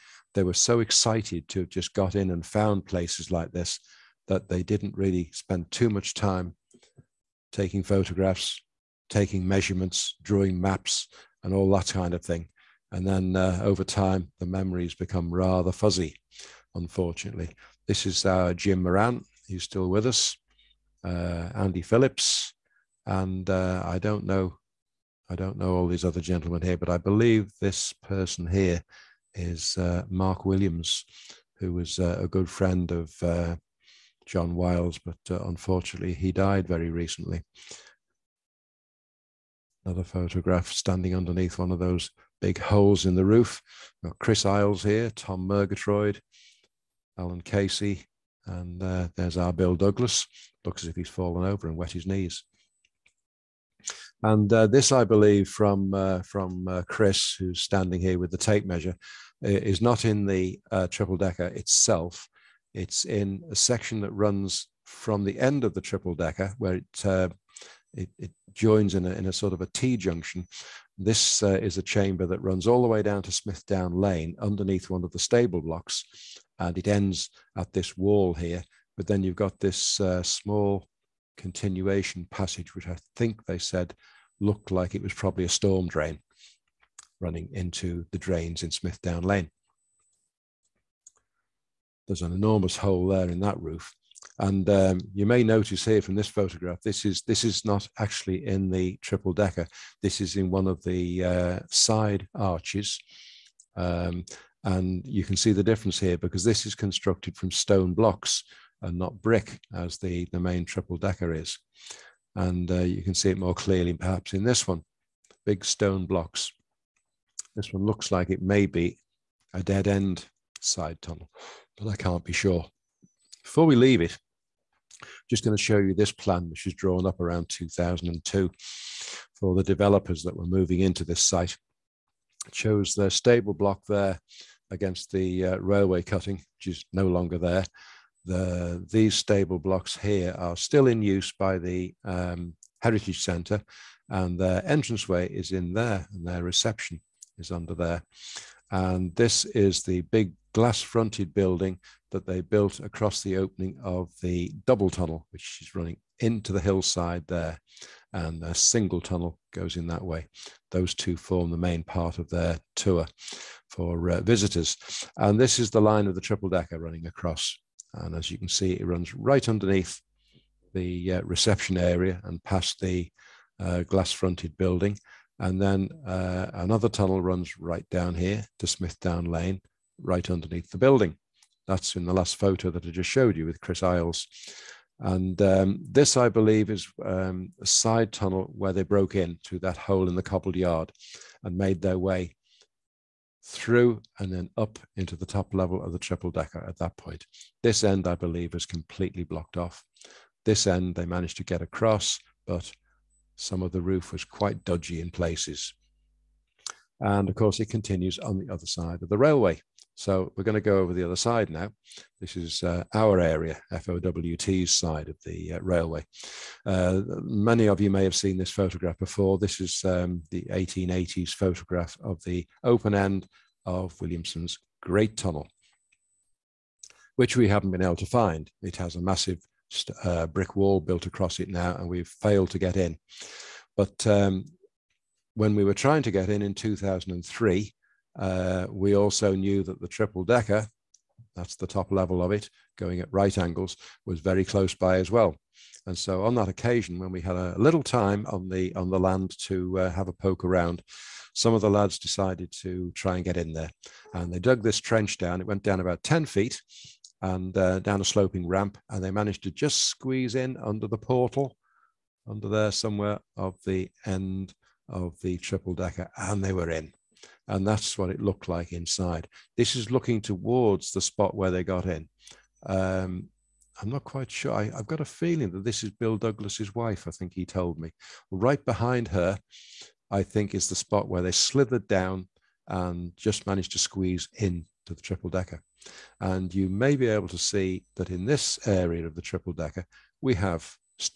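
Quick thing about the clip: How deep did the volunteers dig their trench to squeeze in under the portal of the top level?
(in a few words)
About 10 feet.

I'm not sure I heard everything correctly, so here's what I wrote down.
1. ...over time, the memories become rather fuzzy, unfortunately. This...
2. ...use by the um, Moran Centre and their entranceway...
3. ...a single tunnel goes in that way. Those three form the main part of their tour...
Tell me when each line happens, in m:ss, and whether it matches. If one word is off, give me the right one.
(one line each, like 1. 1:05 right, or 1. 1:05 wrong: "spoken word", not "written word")
1. 0:13 right
2. 2:21 wrong: "Heritage", not "Moran"
3. 2:38 wrong: "two", not "three".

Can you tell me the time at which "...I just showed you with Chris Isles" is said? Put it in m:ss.
3:02.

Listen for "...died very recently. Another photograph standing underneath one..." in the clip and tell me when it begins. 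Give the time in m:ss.
0:36.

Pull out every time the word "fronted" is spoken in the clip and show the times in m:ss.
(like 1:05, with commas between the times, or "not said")
2:30, 2:54.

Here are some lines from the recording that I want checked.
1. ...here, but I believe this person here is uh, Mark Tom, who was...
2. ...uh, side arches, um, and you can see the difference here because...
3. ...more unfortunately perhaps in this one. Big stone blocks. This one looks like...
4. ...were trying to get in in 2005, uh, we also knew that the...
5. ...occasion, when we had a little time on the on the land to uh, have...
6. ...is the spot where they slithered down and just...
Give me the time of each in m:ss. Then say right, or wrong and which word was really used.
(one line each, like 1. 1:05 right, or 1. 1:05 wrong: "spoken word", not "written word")
1. 0:26 wrong: "Williams", not "Tom"
2. 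1:41 right
3. 1:53 wrong: "clearly", not "unfortunately"
4. 3:55 wrong: "2003", not "2005"
5. 4:06 right
6. 4:40 right.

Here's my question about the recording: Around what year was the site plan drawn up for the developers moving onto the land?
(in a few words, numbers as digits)
2002.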